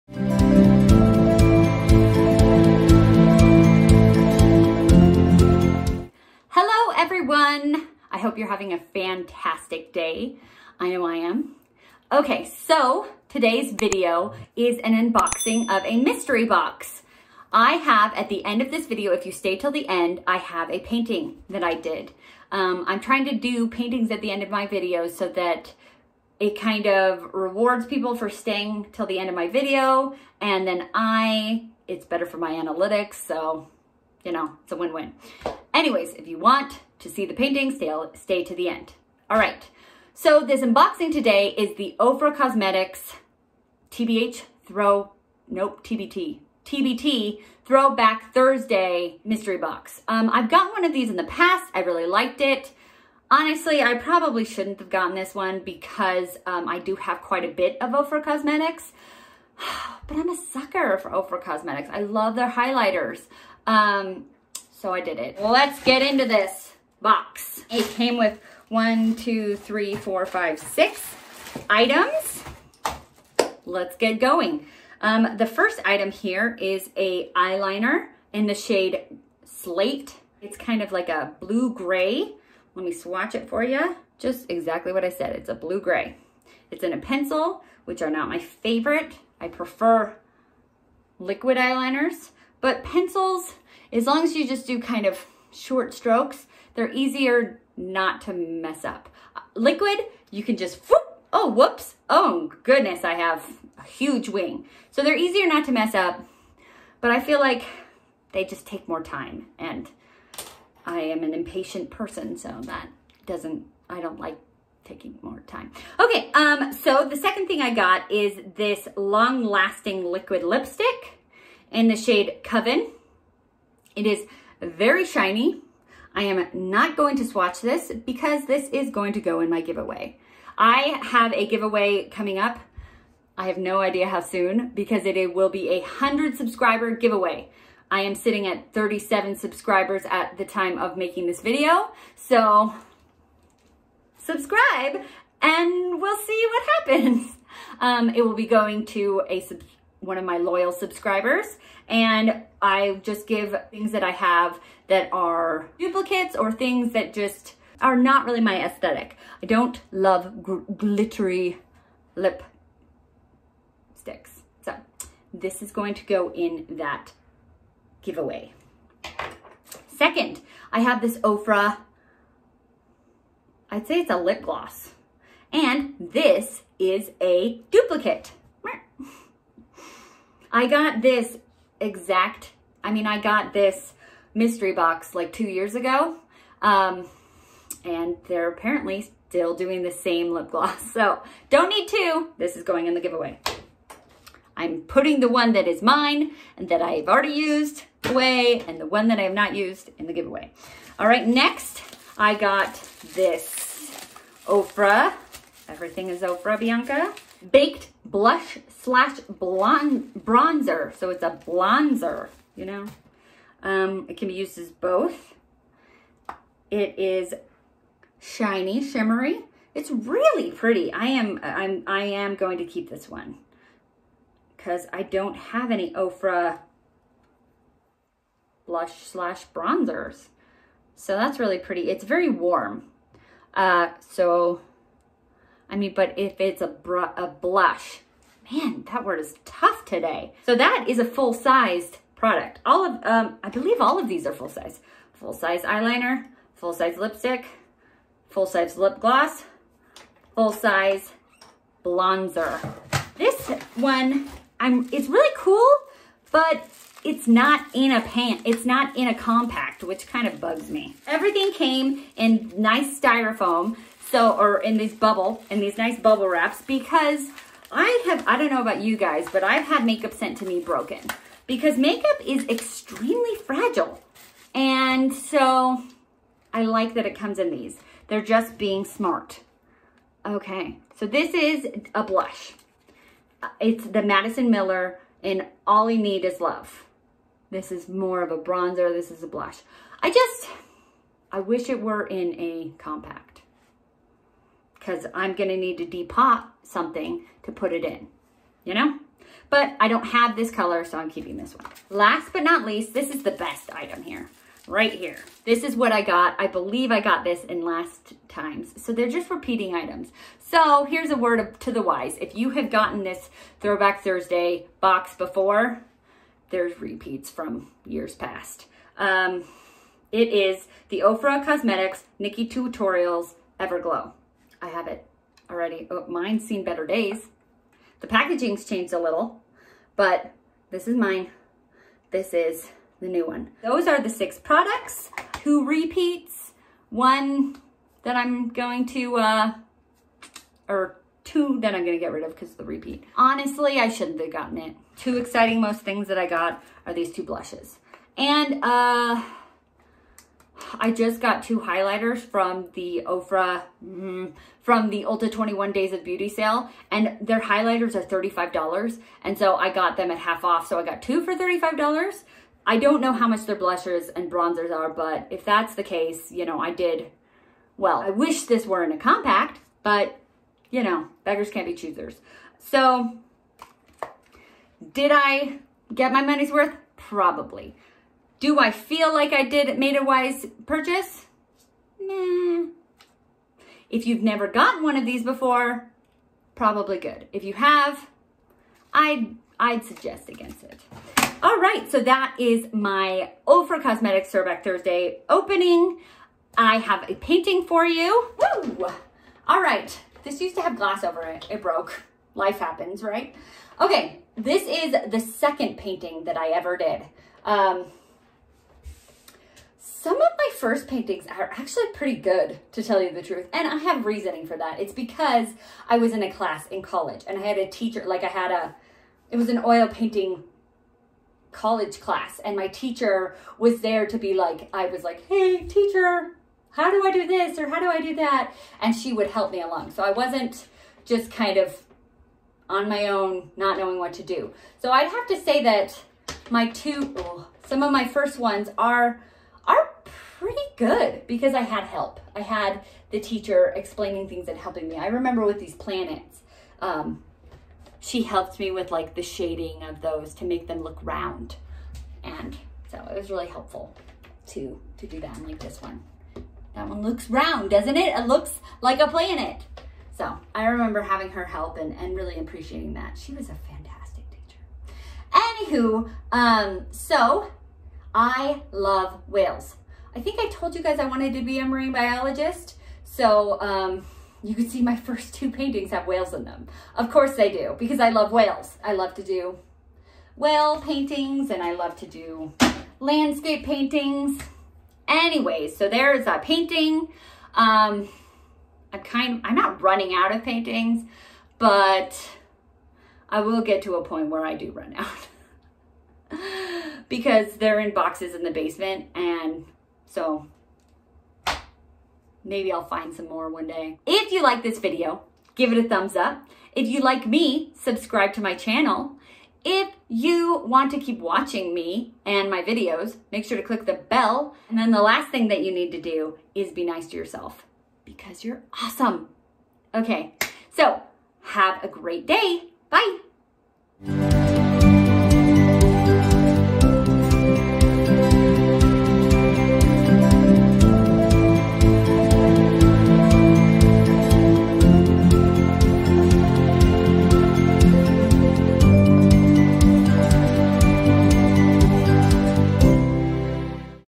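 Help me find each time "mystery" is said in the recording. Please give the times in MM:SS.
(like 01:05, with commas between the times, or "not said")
00:16, 00:49, 03:04.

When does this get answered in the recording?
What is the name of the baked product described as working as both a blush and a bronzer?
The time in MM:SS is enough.
03:26.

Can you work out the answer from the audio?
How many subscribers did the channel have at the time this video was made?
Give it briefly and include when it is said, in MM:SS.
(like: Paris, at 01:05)
37, at 02:18.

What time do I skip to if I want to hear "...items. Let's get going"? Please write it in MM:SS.
01:11.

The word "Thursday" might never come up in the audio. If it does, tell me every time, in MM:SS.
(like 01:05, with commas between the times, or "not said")
00:48, 05:14, 06:34.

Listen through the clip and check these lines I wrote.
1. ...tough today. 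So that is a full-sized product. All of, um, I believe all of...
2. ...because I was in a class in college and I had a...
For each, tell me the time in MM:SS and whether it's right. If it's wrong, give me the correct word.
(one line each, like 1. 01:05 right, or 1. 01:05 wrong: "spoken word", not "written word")
1. 03:59 right
2. 06:54 right.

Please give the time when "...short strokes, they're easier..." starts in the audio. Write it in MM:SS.
01:35.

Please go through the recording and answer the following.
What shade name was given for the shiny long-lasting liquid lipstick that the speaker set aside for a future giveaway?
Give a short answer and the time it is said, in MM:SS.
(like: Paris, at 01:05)
Coven, at 02:02.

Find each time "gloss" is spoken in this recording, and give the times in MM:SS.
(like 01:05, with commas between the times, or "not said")
02:54, 03:10, 04:08.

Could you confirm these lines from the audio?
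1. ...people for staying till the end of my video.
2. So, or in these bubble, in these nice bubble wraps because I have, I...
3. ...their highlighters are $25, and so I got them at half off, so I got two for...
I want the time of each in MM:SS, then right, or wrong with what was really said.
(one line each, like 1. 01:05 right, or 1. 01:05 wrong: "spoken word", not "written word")
1. 00:27 right
2. 04:24 right
3. 05:57 wrong: "35", not "25".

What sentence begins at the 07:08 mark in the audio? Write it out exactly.
And she would help me along.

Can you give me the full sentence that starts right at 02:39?
I don't love glittery lip sticks.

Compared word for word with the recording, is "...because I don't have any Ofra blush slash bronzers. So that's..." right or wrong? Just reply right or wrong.
right.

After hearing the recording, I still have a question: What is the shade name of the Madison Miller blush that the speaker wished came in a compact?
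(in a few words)
All You Need Is Love.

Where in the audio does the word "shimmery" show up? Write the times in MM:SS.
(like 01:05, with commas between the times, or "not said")
03:38.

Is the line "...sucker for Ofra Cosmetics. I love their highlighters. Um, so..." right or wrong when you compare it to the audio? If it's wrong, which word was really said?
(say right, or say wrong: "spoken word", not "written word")
right.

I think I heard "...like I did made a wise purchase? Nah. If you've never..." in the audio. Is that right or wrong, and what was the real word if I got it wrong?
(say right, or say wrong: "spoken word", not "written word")
right.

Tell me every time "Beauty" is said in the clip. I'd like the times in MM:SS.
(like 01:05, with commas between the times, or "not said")
05:56.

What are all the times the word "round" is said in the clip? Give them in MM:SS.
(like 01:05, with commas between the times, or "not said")
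07:31, 07:37.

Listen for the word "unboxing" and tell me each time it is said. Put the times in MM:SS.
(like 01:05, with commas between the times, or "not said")
00:14, 00:40.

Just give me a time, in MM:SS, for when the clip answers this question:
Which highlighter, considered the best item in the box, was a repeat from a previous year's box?
05:22.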